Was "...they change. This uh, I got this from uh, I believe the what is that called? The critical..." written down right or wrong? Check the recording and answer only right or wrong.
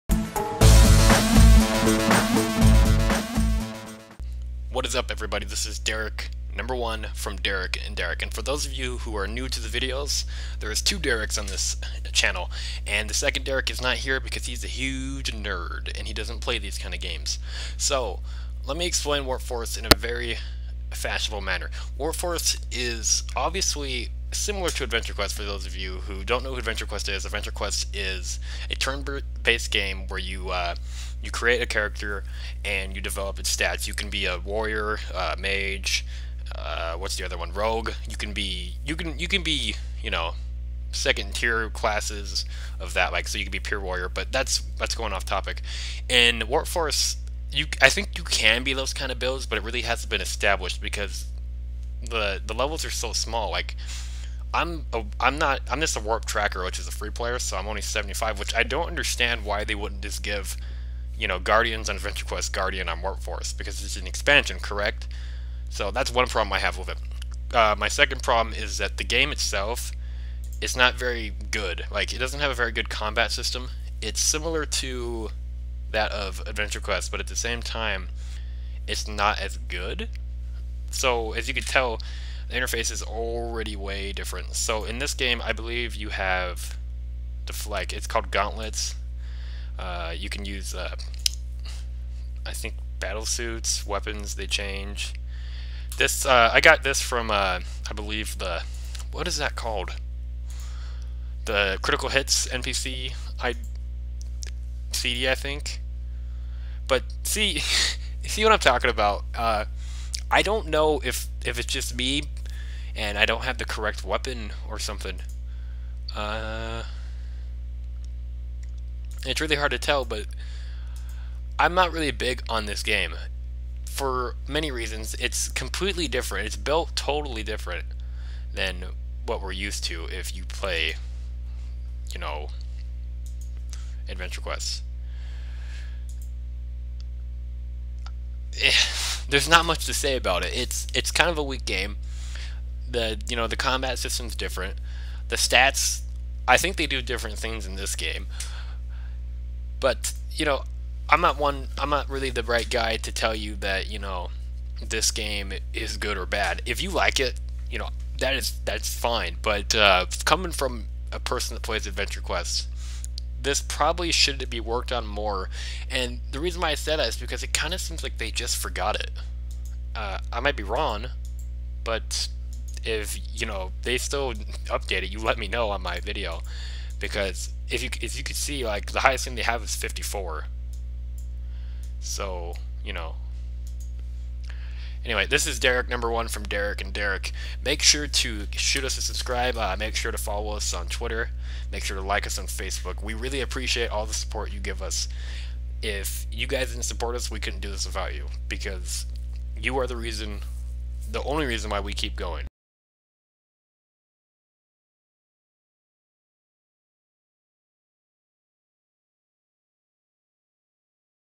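right.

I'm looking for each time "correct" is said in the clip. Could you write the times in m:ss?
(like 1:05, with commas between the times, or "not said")
1:04, 1:53.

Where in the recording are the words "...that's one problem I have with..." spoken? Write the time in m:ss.
1:05.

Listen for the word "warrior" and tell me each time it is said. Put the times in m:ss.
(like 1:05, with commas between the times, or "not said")
0:34, 0:43.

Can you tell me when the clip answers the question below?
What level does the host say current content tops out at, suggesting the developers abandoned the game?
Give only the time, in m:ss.
2:59.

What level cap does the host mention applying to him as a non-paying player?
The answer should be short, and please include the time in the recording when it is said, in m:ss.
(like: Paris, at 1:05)
75, at 0:57.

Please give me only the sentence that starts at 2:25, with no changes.
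The stats, I think they do different things in this game.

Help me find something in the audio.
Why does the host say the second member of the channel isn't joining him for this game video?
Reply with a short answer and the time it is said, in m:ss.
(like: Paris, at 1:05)
He's a huge nerd, at 0:14.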